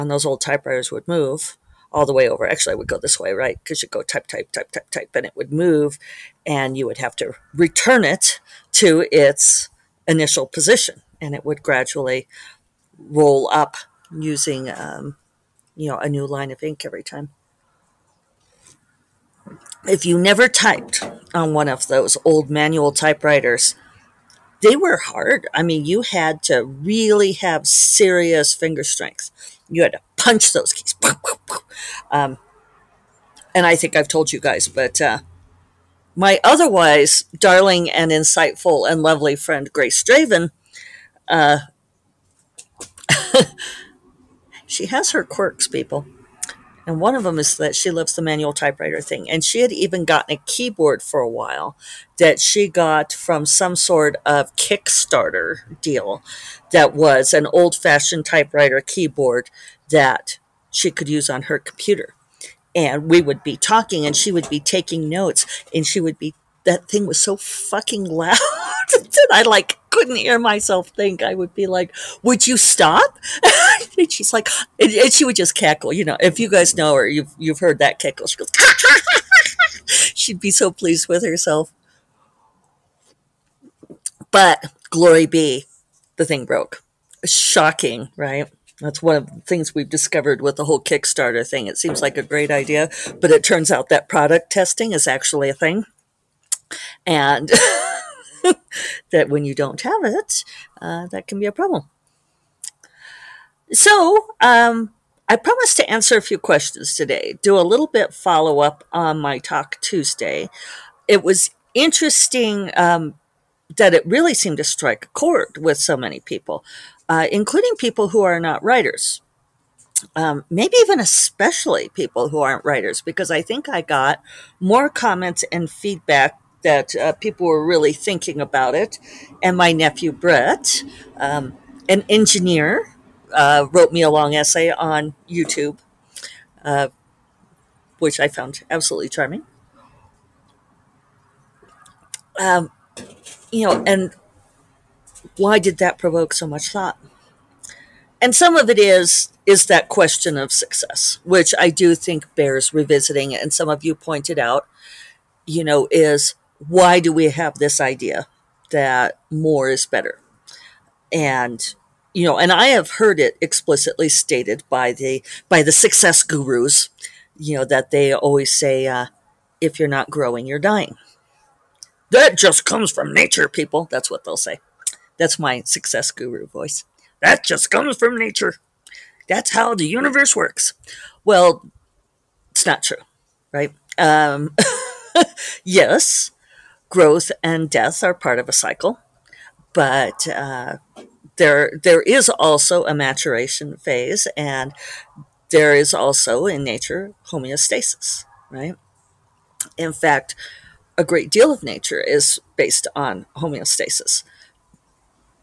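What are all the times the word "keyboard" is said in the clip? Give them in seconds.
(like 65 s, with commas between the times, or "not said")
50 s, 58 s.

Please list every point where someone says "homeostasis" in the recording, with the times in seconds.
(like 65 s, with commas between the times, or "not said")
197 s, 203 s.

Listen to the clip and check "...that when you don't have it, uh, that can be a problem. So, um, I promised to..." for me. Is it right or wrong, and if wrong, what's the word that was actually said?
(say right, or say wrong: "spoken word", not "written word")
right.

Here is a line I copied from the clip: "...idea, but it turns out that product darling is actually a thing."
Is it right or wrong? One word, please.
wrong.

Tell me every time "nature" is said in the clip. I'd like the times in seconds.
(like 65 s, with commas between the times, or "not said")
173 s, 178 s, 196 s, 201 s.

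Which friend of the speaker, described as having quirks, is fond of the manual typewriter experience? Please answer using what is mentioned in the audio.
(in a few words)
Grace Draven.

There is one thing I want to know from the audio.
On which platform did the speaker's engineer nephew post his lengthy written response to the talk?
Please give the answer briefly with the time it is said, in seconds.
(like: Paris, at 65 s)
YouTube, at 135 s.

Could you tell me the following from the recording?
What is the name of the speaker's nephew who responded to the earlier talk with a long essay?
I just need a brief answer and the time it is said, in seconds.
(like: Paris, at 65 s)
Brett, at 130 s.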